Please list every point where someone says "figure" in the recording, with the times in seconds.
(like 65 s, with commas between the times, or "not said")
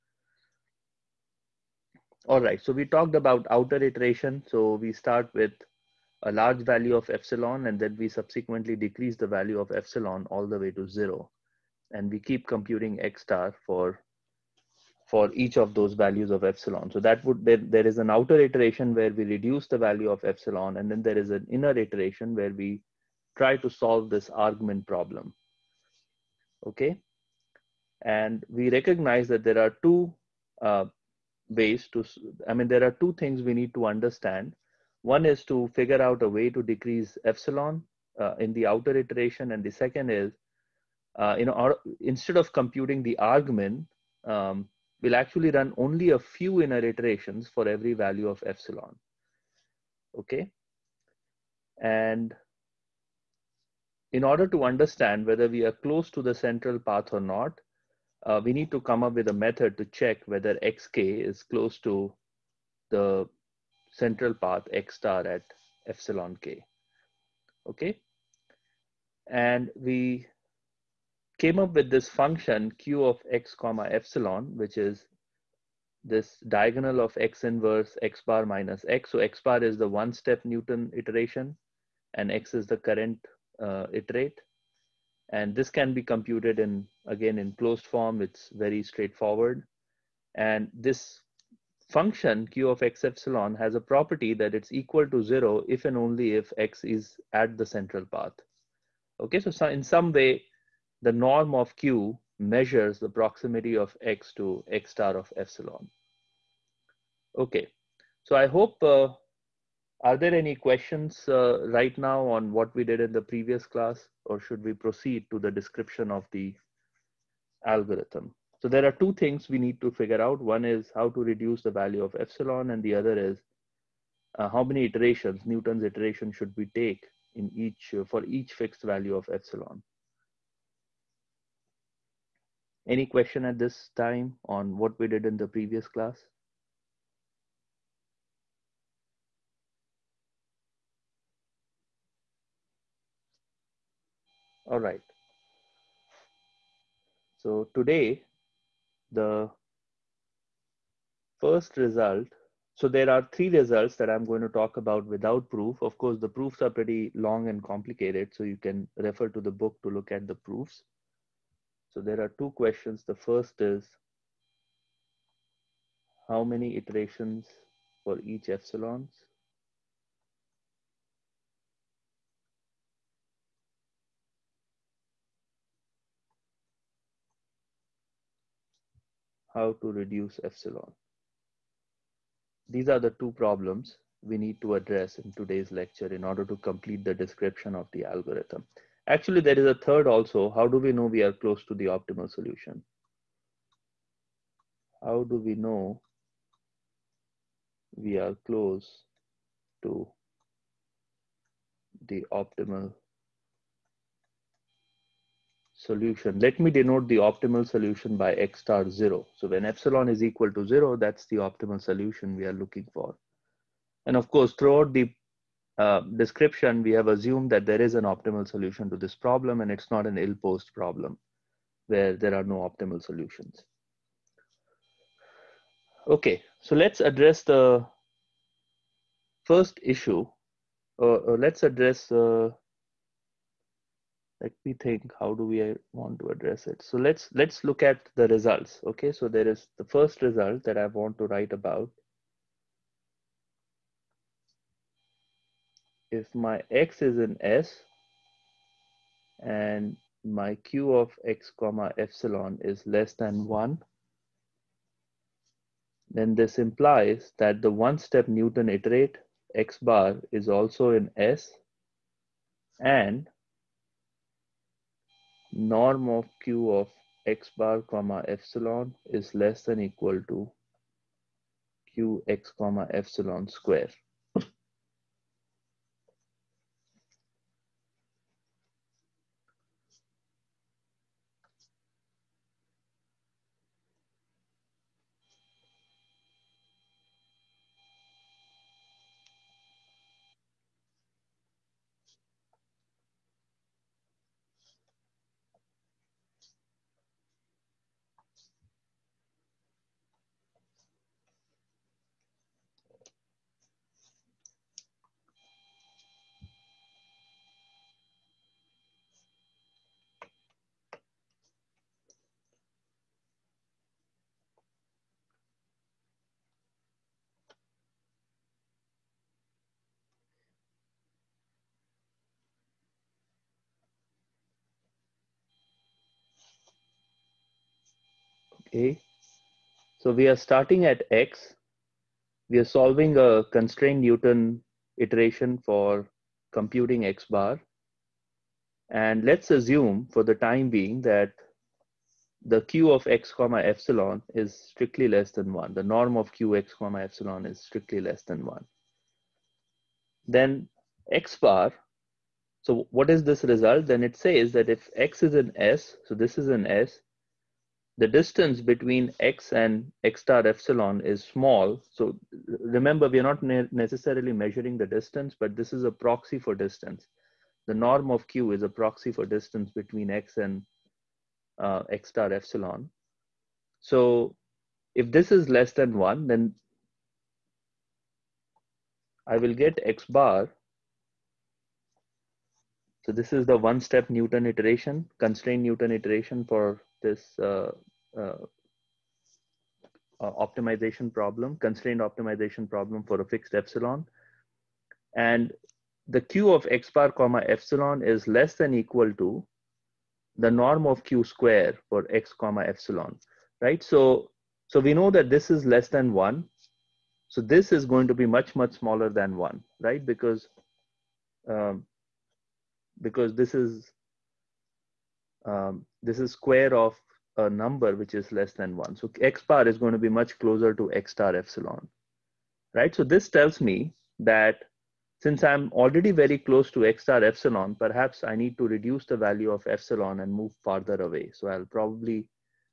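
35 s, 119 s.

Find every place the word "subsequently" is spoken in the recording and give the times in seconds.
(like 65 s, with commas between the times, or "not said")
8 s.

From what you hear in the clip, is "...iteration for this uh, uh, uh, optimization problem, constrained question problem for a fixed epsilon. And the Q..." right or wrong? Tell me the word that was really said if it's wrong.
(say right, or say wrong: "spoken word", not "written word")
wrong: "optimization", not "question".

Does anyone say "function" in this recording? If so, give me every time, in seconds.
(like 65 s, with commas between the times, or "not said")
72 s, 91 s.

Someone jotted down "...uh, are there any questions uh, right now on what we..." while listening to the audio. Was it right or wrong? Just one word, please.
right.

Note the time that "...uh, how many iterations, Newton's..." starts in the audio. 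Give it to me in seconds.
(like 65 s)
124 s.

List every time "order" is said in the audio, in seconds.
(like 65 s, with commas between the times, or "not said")
54 s, 186 s.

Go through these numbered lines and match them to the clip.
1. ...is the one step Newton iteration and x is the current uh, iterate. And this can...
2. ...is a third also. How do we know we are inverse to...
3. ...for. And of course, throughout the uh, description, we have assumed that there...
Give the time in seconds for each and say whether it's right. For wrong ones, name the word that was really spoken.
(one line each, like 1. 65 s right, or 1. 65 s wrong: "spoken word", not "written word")
1. 79 s right
2. 189 s wrong: "close", not "inverse"
3. 212 s right.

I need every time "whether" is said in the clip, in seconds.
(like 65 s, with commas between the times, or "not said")
55 s, 60 s.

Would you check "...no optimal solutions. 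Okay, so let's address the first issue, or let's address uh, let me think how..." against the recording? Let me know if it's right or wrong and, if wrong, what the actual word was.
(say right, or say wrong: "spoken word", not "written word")
right.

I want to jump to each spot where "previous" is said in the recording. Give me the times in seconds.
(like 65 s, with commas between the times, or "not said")
113 s, 135 s.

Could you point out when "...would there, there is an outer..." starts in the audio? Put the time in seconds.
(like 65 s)
17 s.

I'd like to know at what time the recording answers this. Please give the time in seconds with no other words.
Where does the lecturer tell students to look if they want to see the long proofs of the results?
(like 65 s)
159 s.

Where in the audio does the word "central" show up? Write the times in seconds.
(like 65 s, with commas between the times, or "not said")
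56 s, 63 s, 97 s.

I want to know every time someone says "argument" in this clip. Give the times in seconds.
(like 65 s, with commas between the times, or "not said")
24 s, 43 s.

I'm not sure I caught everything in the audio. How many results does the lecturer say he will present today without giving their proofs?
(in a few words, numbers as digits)
3.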